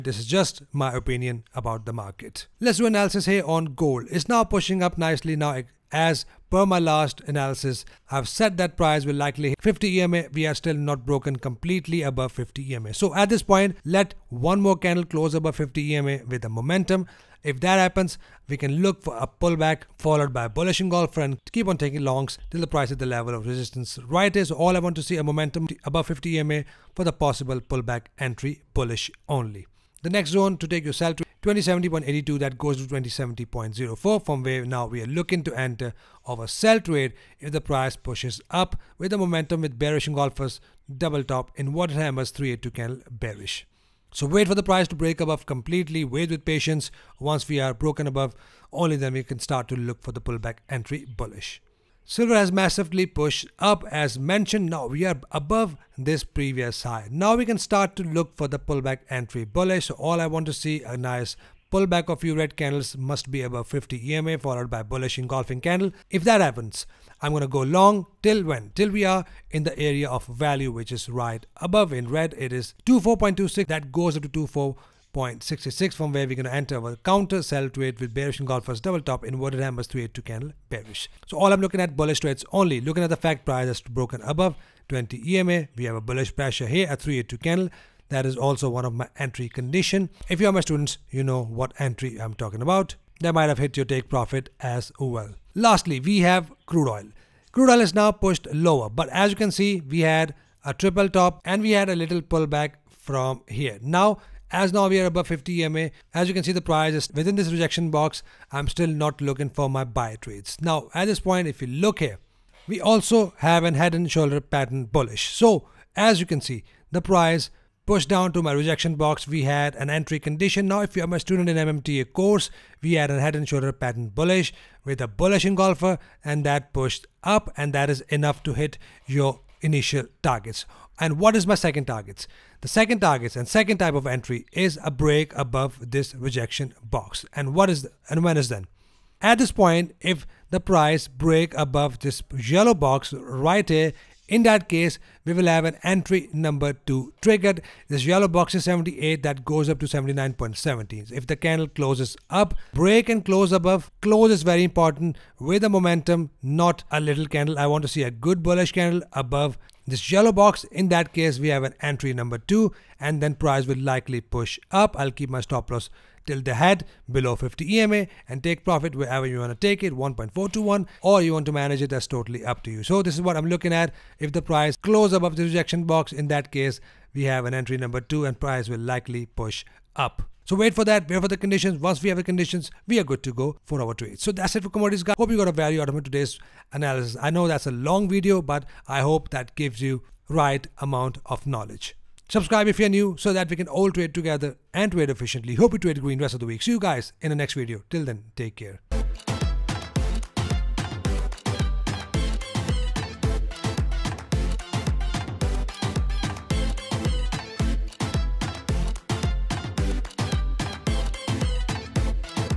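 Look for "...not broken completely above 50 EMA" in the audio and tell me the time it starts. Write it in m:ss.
0:10.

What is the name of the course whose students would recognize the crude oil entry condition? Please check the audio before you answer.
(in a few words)
MMTA.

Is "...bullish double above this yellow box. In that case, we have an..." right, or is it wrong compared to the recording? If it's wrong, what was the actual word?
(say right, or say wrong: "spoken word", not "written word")
wrong: "candle", not "double".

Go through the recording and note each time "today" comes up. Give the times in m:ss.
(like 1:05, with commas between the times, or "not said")
3:06.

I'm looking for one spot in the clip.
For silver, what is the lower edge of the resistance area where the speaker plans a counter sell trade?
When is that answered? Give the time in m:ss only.
1:12.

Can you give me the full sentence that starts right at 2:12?
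The second targets and second type of entry is a break above this rejection box.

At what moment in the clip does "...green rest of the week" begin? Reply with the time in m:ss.
3:16.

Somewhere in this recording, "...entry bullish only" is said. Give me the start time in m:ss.
0:28.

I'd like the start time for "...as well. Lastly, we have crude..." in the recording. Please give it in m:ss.
1:34.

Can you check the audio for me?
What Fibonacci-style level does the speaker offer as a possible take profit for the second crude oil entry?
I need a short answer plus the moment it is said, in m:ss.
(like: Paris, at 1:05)
1.421, at 2:49.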